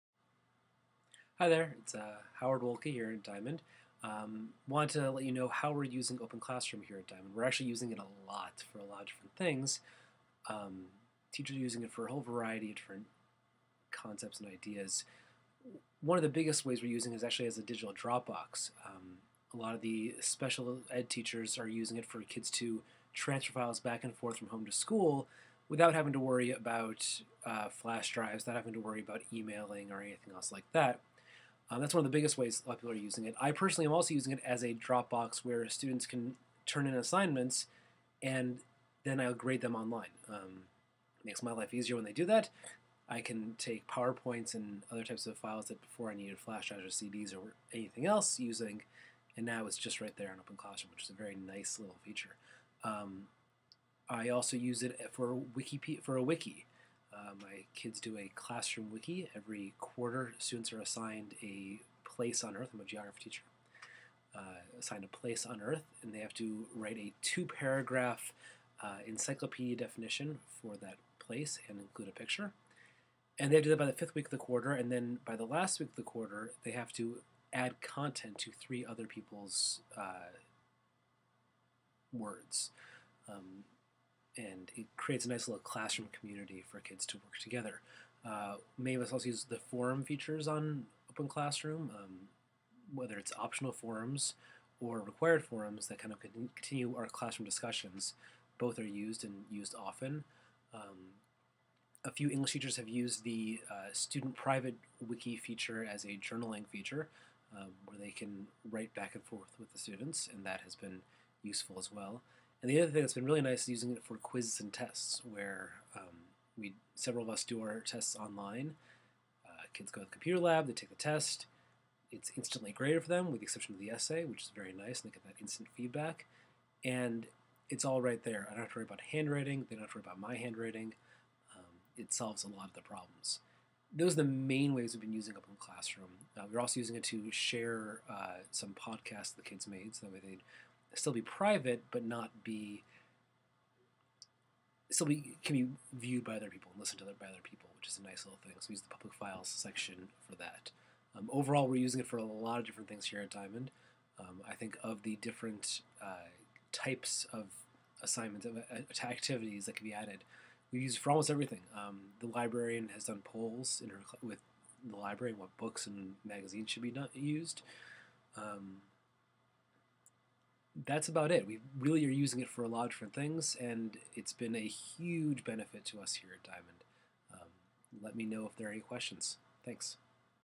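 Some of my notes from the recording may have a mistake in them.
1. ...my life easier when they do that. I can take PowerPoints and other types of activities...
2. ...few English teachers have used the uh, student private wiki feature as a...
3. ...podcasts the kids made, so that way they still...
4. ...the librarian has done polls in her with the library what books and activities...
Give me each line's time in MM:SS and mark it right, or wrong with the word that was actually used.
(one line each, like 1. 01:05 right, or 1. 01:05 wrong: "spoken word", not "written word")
1. 00:41 wrong: "files", not "activities"
2. 01:42 right
3. 02:18 right
4. 02:42 wrong: "magazines", not "activities".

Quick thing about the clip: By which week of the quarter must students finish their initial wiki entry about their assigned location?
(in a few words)
Fifth week.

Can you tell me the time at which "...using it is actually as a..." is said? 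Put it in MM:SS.
00:16.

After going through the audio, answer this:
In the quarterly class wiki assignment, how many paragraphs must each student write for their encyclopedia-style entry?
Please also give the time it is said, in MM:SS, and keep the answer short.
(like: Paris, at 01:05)
2, at 01:07.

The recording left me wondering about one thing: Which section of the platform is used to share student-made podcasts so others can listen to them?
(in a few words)
Public files section.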